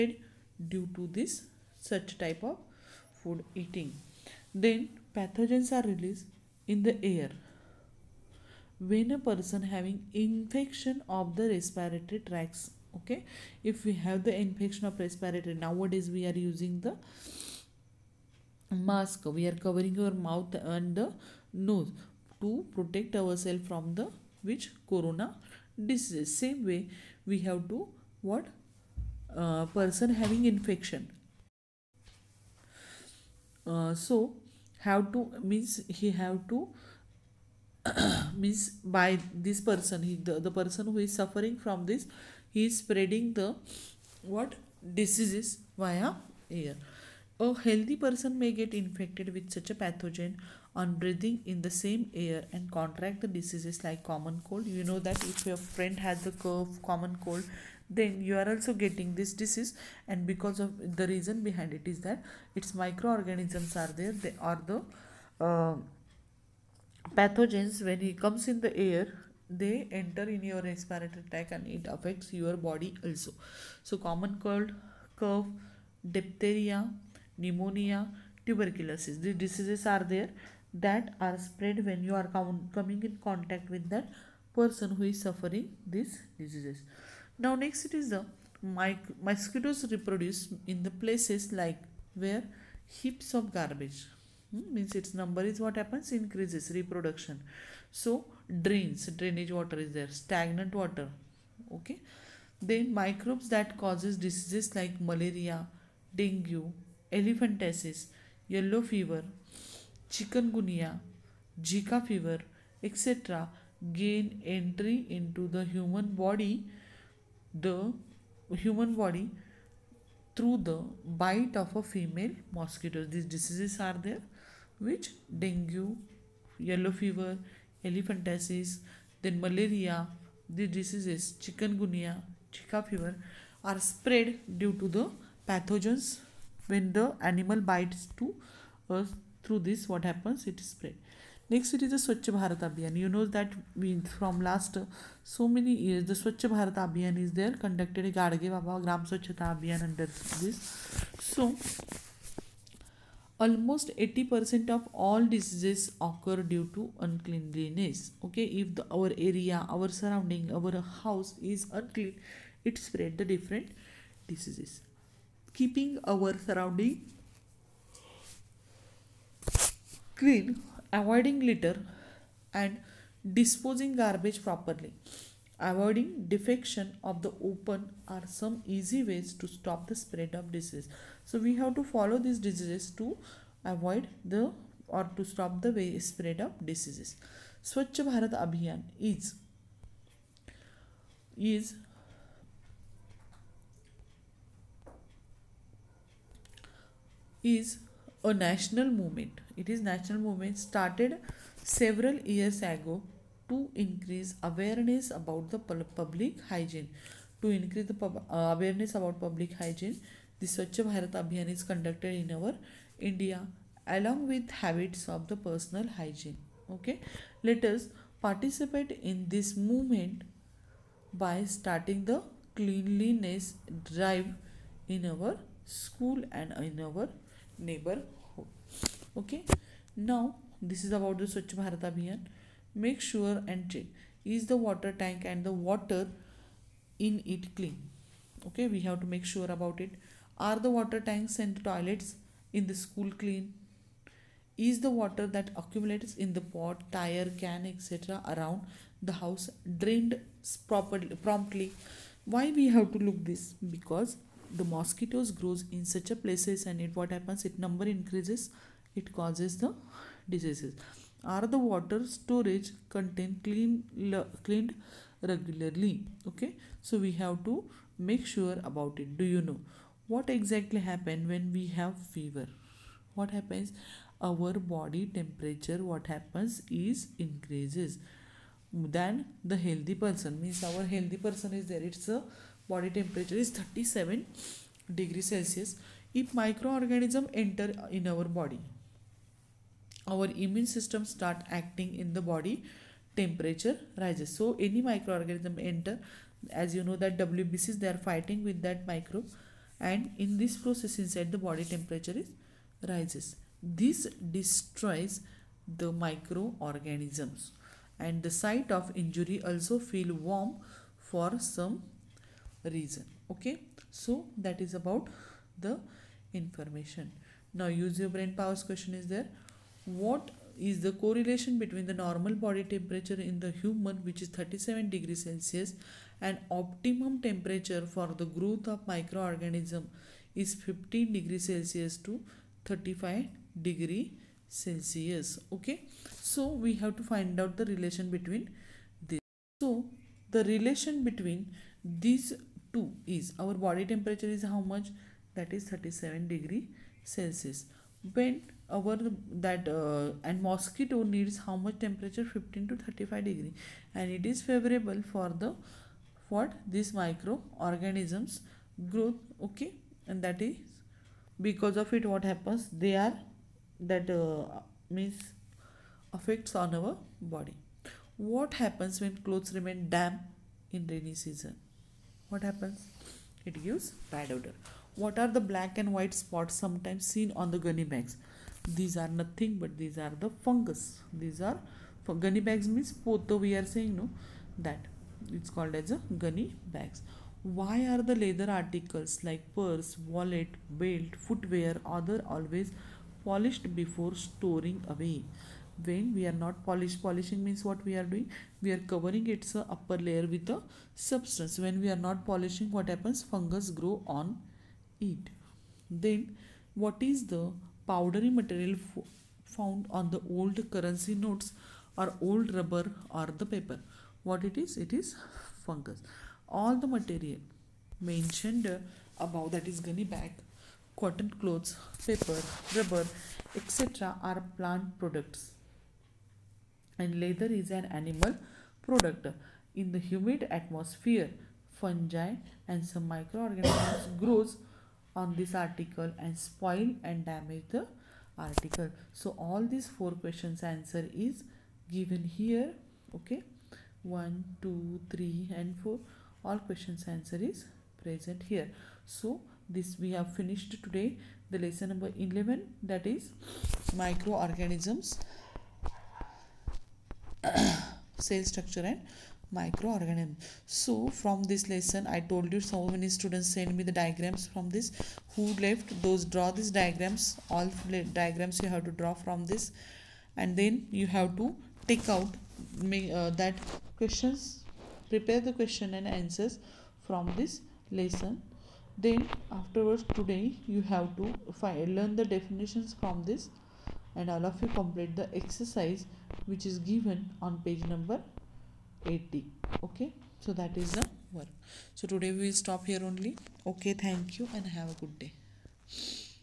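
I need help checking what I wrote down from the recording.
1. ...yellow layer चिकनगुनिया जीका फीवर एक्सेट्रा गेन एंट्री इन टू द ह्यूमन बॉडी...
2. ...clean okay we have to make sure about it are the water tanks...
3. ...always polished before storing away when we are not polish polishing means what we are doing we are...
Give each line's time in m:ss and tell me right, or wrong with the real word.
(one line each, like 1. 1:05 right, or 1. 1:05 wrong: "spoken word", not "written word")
1. 1:48 wrong: "fever", not "layer"
2. 3:57 right
3. 6:32 right.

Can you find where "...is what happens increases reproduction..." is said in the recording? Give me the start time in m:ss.
1:35.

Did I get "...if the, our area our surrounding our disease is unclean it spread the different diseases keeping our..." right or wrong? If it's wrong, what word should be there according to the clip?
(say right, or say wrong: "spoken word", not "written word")
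wrong: "house", not "disease".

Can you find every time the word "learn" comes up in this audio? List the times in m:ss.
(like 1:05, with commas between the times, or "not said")
8:01.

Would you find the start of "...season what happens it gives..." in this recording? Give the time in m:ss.
6:11.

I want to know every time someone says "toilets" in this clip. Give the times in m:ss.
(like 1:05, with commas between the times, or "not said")
4:01.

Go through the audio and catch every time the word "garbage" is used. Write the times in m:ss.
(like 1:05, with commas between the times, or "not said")
1:33, 2:53.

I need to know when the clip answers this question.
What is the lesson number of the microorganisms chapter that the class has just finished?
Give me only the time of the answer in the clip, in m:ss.
7:31.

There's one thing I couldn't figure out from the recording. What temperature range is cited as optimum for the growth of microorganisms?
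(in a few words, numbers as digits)
15 to 35 degrees Celsius.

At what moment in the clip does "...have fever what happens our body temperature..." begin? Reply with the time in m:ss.
4:31.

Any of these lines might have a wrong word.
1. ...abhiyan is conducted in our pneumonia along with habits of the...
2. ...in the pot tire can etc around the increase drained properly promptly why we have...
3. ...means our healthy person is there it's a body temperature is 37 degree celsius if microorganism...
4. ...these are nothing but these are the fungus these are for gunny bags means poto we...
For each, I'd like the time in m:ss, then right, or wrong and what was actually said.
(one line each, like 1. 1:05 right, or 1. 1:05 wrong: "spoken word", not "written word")
1. 3:31 wrong: "india", not "pneumonia"
2. 4:06 wrong: "house", not "increase"
3. 4:40 right
4. 6:18 right.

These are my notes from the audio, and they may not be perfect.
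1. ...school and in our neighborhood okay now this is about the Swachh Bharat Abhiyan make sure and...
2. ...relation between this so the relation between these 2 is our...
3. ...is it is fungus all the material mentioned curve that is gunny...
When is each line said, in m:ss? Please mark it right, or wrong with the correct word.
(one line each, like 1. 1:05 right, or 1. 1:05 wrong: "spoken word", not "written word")
1. 3:45 right
2. 5:37 right
3. 6:54 wrong: "above", not "curve".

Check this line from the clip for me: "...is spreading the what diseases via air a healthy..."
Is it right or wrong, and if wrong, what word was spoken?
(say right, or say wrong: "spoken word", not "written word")
right.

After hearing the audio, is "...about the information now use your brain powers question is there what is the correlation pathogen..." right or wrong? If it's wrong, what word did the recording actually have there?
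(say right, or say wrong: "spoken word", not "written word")
wrong: "between", not "pathogen".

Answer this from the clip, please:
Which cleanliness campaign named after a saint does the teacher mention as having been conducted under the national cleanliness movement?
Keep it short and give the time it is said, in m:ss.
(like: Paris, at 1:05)
Gadge Baba Gram Swachhata Abhiyan, at 2:28.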